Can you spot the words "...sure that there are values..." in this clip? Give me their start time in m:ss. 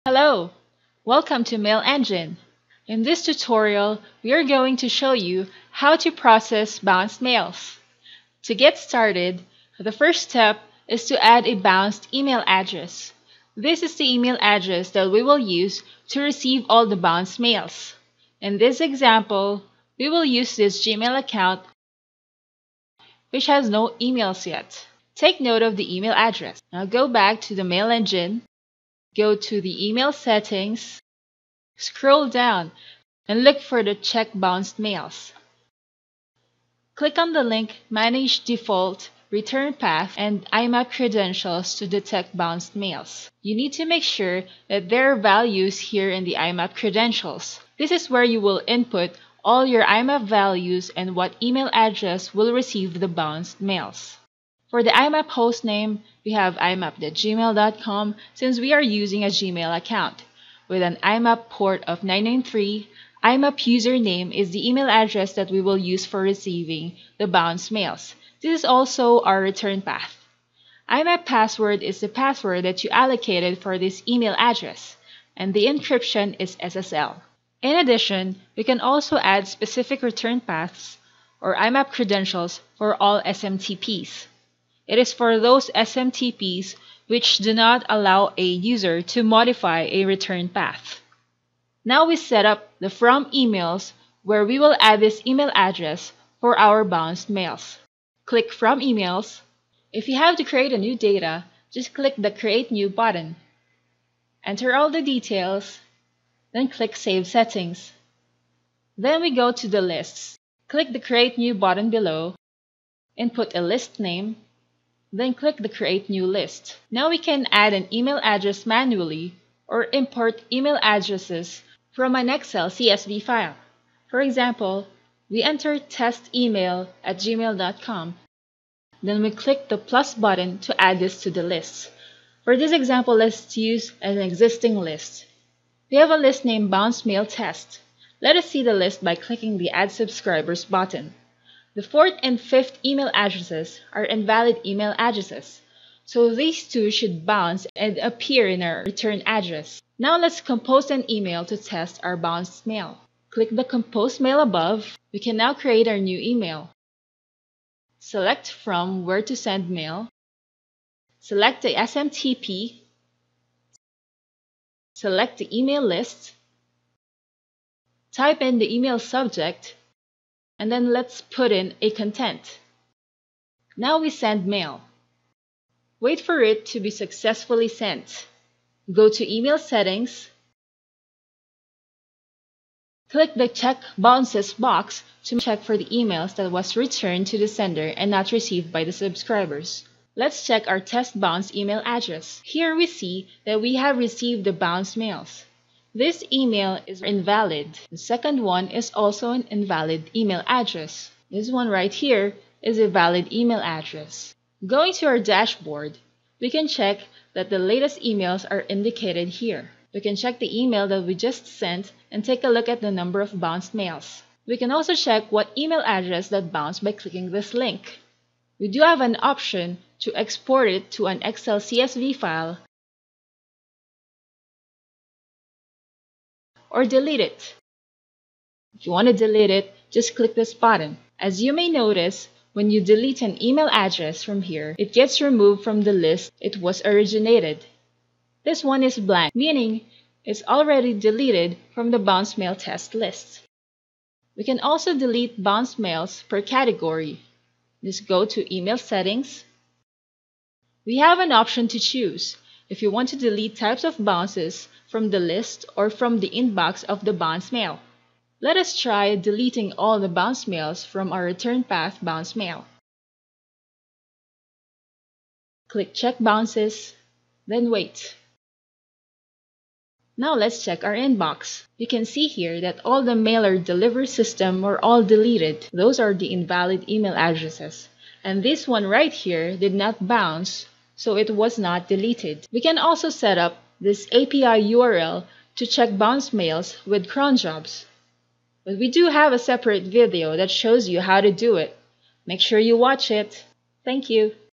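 0:44.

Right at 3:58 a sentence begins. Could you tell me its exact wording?
This one is blank, meaning it's already deleted from the bounce mail test list.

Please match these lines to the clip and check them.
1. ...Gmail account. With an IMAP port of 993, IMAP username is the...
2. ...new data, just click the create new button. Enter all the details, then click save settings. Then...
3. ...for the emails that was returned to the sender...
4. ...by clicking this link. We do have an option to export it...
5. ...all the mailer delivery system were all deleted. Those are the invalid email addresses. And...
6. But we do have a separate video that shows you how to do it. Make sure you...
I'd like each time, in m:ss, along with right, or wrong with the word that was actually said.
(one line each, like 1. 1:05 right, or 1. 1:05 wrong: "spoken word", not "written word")
1. 0:59 right
2. 1:40 right
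3. 3:05 right
4. 3:36 right
5. 4:32 right
6. 4:48 right.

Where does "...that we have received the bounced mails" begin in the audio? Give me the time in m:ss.
3:13.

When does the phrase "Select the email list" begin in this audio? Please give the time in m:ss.
2:44.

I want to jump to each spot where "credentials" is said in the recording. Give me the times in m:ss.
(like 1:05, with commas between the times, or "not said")
0:40, 0:46, 1:21.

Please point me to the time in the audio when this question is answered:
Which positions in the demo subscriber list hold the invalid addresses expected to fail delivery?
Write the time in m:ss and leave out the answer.
2:21.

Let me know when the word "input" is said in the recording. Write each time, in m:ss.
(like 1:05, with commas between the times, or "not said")
0:48, 1:53.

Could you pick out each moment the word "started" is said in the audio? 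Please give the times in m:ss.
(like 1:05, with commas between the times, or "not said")
0:08.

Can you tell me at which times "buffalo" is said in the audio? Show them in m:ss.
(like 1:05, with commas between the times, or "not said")
not said.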